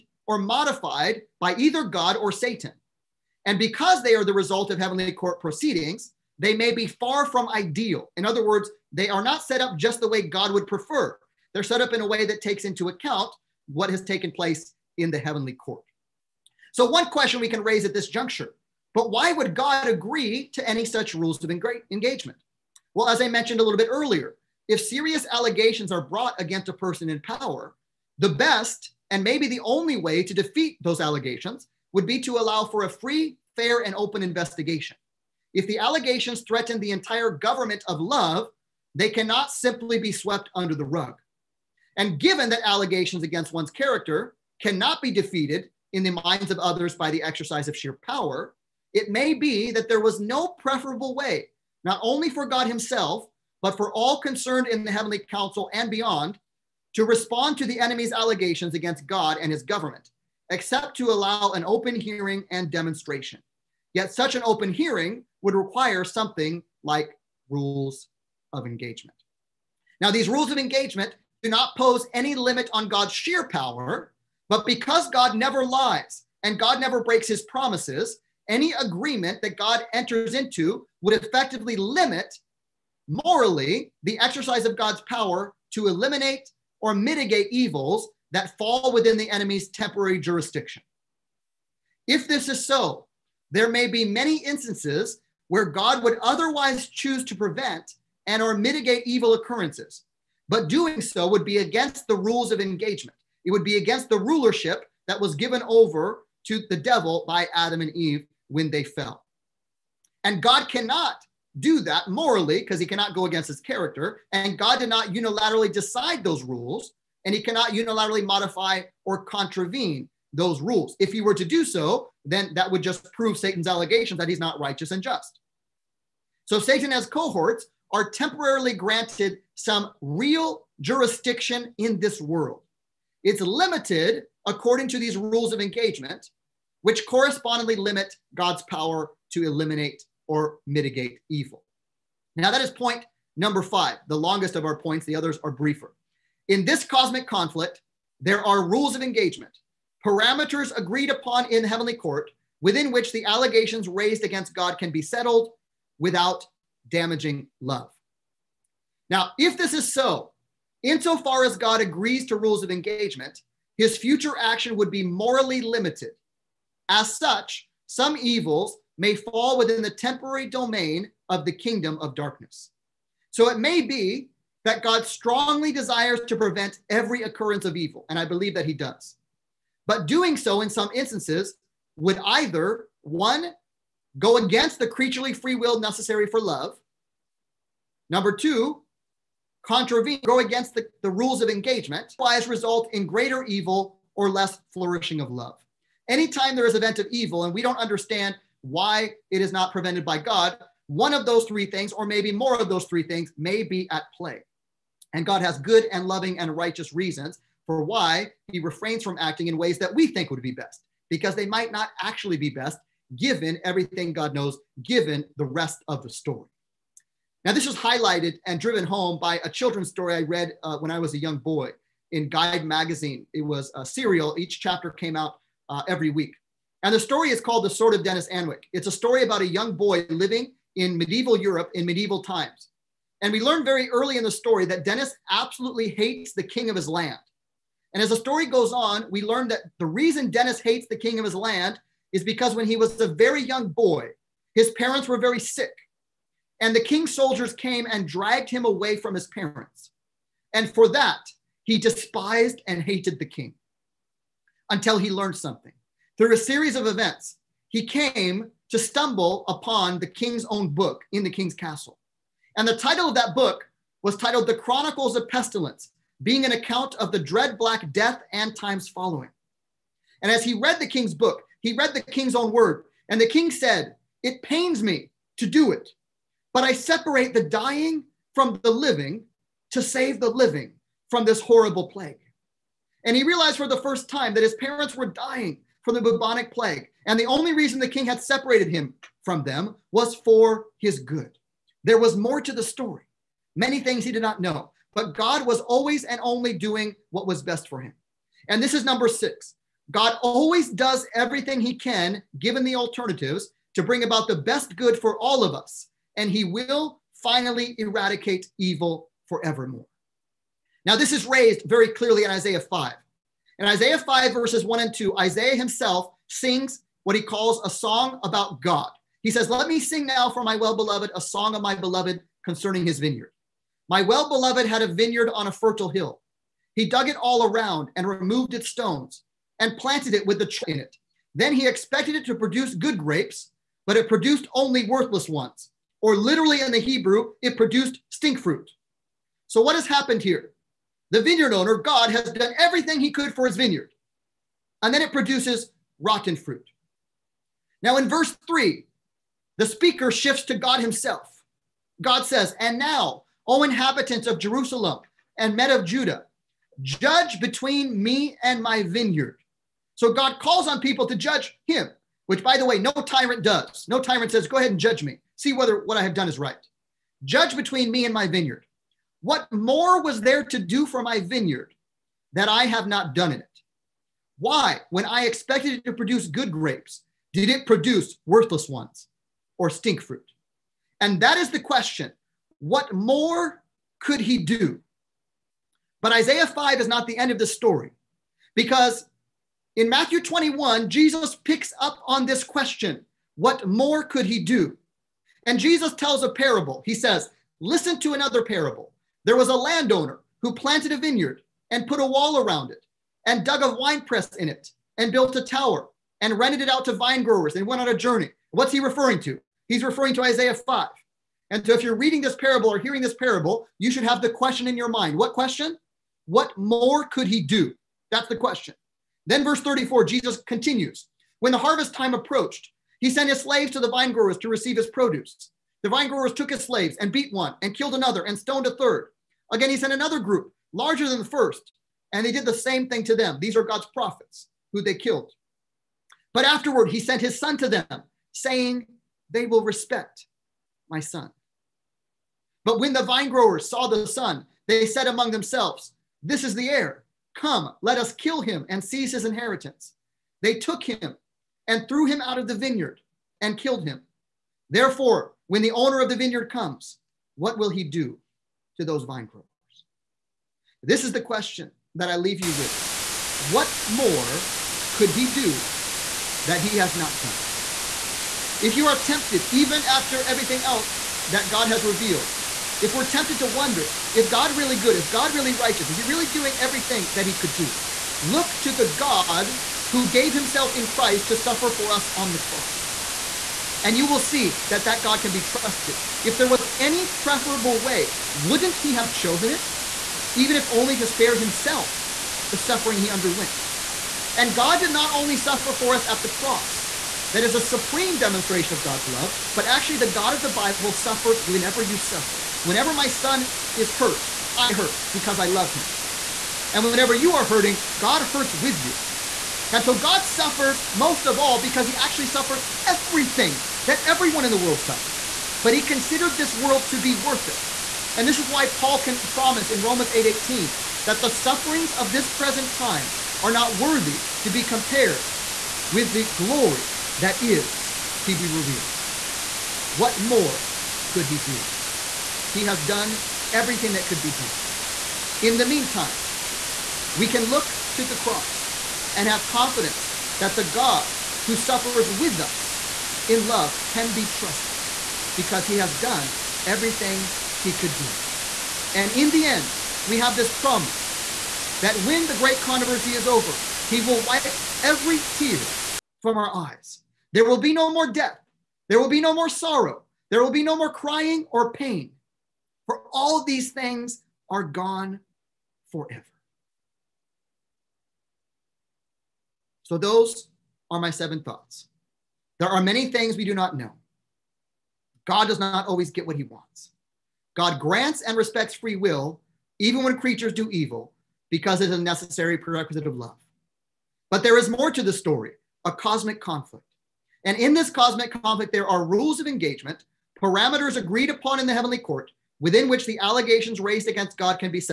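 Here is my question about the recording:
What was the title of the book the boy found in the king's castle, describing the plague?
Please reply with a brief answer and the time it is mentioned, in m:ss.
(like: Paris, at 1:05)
The Chronicles of Pestilence, at 4:24.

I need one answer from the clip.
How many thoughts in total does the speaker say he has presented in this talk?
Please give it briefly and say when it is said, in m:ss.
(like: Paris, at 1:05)
7, at 9:31.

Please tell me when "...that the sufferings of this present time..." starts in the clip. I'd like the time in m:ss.
8:41.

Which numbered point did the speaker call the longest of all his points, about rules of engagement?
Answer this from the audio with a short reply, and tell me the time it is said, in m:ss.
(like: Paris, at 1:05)
5, at 2:22.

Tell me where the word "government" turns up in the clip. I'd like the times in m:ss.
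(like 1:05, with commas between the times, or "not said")
0:37, 0:59.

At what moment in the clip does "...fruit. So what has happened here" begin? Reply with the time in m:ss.
5:38.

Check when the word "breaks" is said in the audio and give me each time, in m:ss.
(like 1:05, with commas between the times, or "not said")
1:17.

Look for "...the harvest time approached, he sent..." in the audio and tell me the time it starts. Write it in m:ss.
7:01.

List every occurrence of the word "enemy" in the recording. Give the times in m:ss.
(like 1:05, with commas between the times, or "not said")
0:57, 1:29.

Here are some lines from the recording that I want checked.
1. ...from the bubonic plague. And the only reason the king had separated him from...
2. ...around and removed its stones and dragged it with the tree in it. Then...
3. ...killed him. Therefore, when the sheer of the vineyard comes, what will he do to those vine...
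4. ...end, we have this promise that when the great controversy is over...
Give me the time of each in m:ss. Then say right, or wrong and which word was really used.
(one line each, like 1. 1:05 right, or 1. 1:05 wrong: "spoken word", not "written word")
1. 4:45 right
2. 5:27 wrong: "planted", not "dragged"
3. 7:33 wrong: "owner", not "sheer"
4. 9:09 right.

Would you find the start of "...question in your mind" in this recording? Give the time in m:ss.
6:54.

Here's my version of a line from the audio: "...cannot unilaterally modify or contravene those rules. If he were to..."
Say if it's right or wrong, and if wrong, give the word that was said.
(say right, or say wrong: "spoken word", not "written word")
right.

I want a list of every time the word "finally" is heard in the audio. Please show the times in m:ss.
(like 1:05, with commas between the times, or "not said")
5:07.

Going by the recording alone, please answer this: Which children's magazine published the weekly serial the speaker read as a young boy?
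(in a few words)
Guide magazine.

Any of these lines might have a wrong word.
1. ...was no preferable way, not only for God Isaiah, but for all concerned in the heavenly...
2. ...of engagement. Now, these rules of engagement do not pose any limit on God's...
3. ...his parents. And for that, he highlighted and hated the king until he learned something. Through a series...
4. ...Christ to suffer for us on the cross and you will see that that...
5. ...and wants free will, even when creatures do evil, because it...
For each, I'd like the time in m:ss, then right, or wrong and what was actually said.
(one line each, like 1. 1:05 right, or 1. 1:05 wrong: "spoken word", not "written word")
1. 0:50 wrong: "Himself", not "Isaiah"
2. 1:08 right
3. 4:09 wrong: "despised", not "highlighted"
4. 8:00 right
5. 9:38 wrong: "respects", not "wants".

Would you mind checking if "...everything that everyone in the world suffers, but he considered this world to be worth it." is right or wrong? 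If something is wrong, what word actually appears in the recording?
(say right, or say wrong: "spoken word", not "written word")
right.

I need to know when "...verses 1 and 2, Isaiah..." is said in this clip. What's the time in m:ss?
5:14.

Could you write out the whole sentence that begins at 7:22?
But when the vinegrowers saw the son, they said among themselves, This is the heir.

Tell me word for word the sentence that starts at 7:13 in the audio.
These are God's prophets who they killed.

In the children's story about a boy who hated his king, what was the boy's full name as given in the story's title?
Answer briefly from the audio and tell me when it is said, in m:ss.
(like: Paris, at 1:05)
Dennis Anwick, at 3:48.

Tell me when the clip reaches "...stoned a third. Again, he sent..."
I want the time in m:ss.
7:08.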